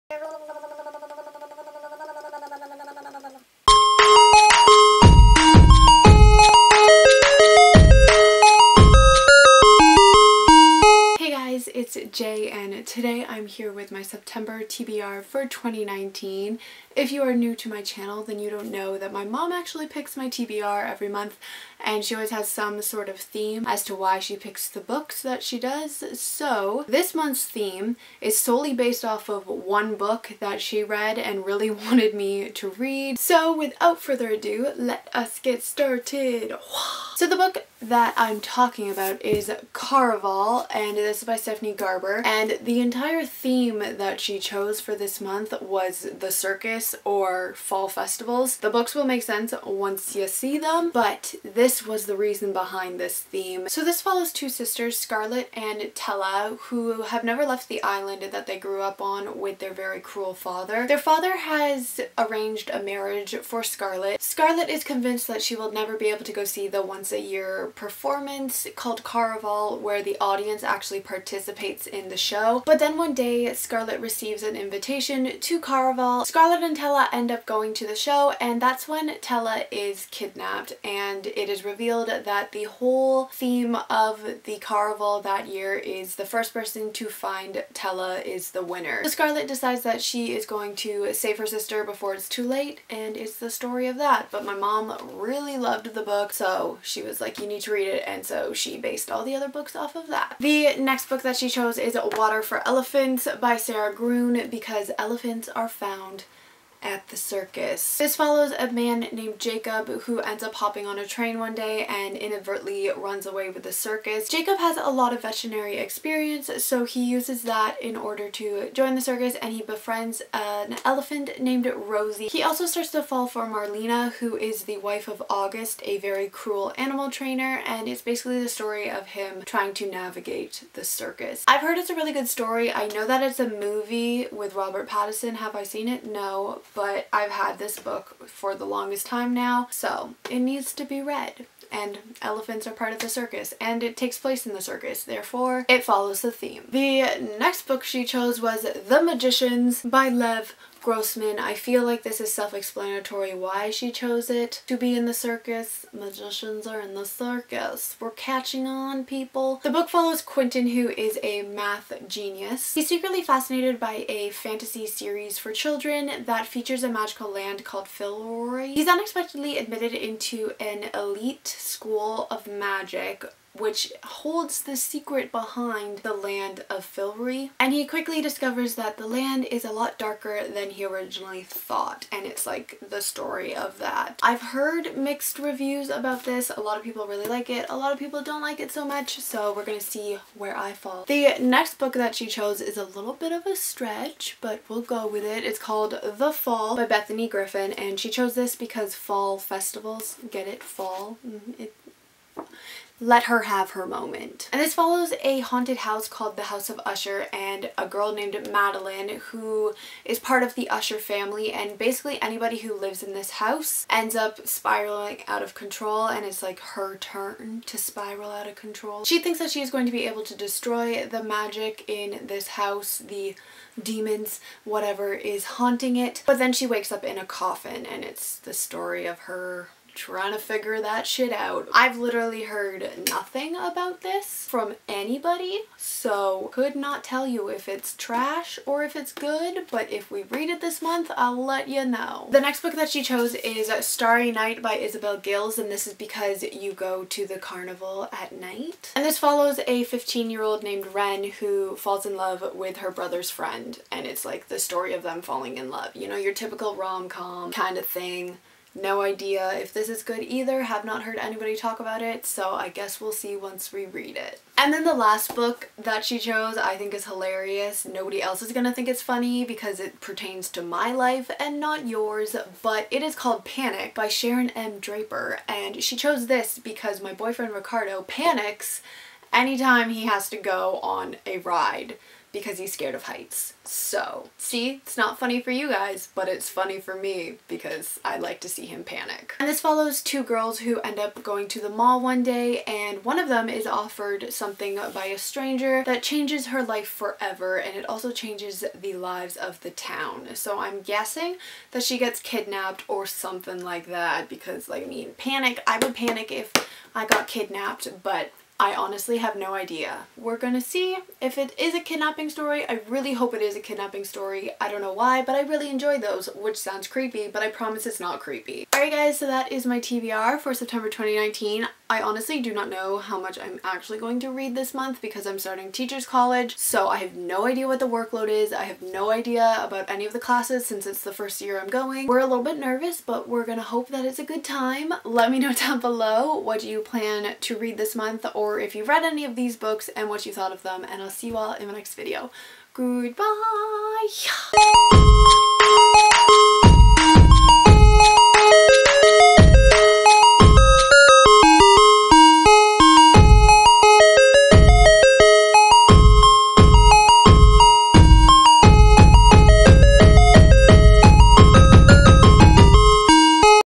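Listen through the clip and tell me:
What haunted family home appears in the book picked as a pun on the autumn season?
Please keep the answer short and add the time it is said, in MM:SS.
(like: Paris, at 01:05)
House of Usher, at 03:26.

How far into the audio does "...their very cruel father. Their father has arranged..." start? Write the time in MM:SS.
00:59.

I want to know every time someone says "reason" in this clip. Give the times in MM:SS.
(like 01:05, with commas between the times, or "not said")
00:52.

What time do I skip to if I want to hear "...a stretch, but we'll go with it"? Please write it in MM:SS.
03:13.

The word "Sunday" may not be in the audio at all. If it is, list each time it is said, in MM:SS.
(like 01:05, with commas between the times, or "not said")
not said.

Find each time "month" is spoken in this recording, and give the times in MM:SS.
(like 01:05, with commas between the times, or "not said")
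00:21, 00:27, 00:45, 04:00, 05:24, 05:37.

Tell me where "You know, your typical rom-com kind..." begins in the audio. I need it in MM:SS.
04:15.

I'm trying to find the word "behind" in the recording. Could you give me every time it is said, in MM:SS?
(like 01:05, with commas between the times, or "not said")
00:52, 02:55.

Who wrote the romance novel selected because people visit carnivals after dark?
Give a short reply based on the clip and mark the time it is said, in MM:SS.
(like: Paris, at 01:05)
Isabel Gillies, at 04:04.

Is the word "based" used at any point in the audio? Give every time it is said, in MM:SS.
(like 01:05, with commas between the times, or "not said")
00:28, 01:38.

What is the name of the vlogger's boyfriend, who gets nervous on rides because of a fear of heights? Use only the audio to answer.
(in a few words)
Ricardo.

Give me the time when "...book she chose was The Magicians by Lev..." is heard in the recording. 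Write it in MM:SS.
02:27.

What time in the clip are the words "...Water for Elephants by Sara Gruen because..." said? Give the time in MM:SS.
01:42.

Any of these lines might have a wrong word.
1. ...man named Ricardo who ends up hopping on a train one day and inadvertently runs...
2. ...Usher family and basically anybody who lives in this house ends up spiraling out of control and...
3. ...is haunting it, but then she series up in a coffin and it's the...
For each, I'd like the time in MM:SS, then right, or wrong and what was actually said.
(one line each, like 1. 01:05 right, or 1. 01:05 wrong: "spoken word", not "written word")
1. 01:48 wrong: "Jacob", not "Ricardo"
2. 03:30 right
3. 03:45 wrong: "wakes", not "series".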